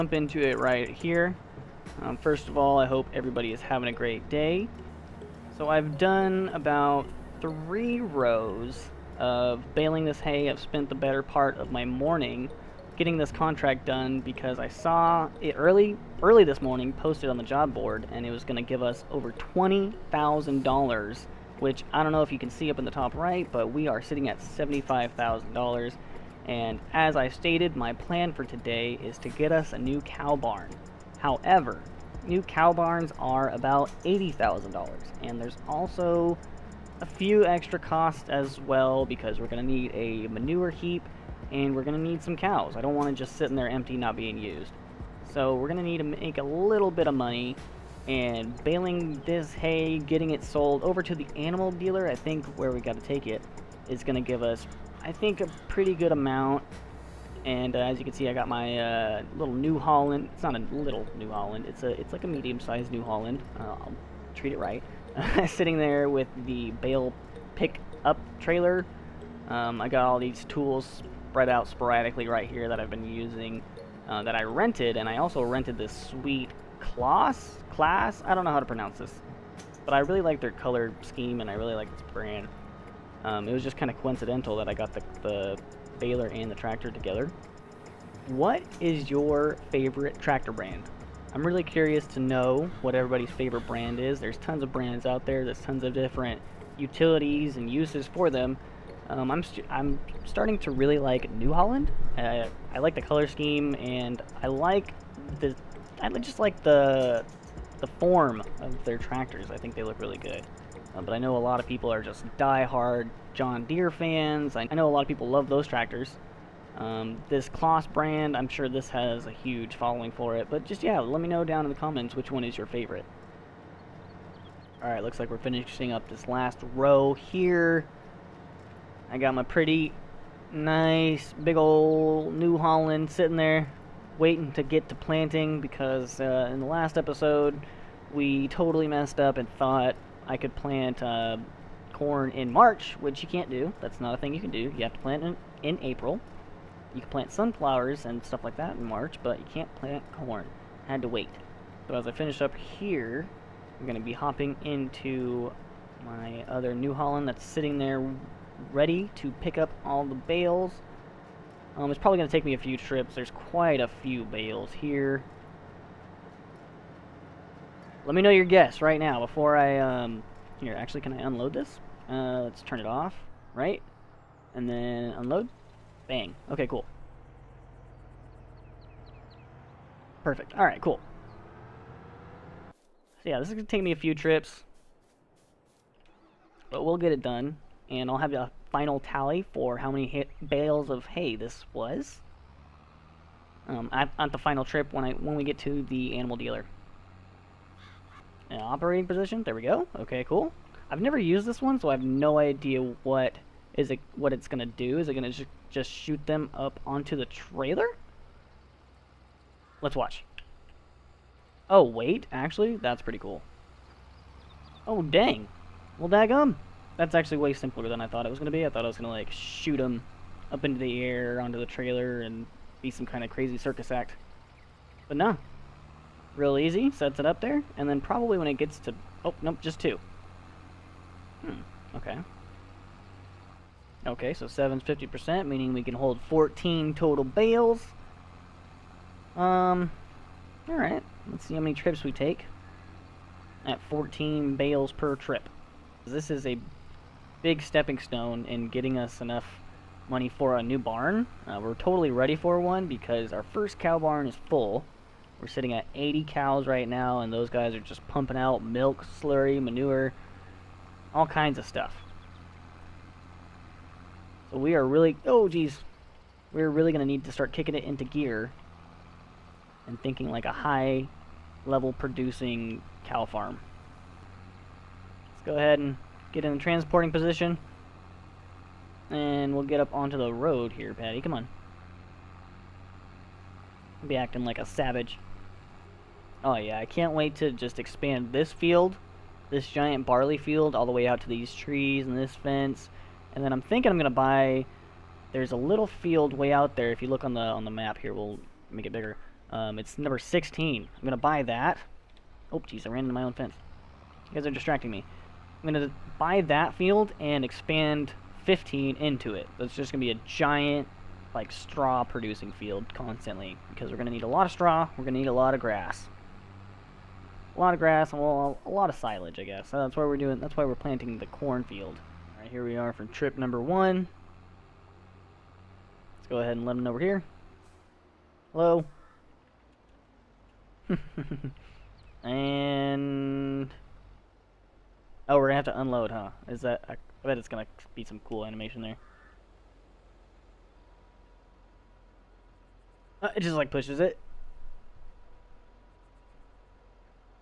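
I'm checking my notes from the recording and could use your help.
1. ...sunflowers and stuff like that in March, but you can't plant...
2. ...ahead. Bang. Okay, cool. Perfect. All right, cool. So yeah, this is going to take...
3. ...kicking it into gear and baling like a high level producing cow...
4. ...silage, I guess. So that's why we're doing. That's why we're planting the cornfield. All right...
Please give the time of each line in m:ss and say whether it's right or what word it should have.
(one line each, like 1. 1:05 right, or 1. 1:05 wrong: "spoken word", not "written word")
1. 2:27 right
2. 2:55 wrong: "unload", not "ahead"
3. 4:27 wrong: "thinking", not "baling"
4. 5:18 right.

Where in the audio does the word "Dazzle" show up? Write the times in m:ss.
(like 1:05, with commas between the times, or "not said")
not said.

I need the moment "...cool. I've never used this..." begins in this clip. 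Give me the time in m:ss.
3:20.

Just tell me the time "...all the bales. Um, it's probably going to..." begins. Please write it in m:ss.
2:39.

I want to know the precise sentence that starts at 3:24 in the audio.
Is it gonna just shoot them up onto the trailer?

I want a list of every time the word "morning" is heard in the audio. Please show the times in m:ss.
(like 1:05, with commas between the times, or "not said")
0:11, 0:16.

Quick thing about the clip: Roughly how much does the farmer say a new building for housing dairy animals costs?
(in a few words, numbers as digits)
$80,000.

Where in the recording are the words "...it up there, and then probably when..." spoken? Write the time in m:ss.
3:47.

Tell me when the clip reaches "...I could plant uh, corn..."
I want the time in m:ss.
2:20.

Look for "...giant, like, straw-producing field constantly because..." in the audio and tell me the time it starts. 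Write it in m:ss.
5:10.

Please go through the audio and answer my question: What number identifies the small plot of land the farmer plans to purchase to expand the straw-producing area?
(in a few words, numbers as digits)
16.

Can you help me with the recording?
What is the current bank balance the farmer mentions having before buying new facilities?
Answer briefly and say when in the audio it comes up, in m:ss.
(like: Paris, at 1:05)
$75,000, at 0:24.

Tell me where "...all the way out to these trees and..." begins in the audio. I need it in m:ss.
4:50.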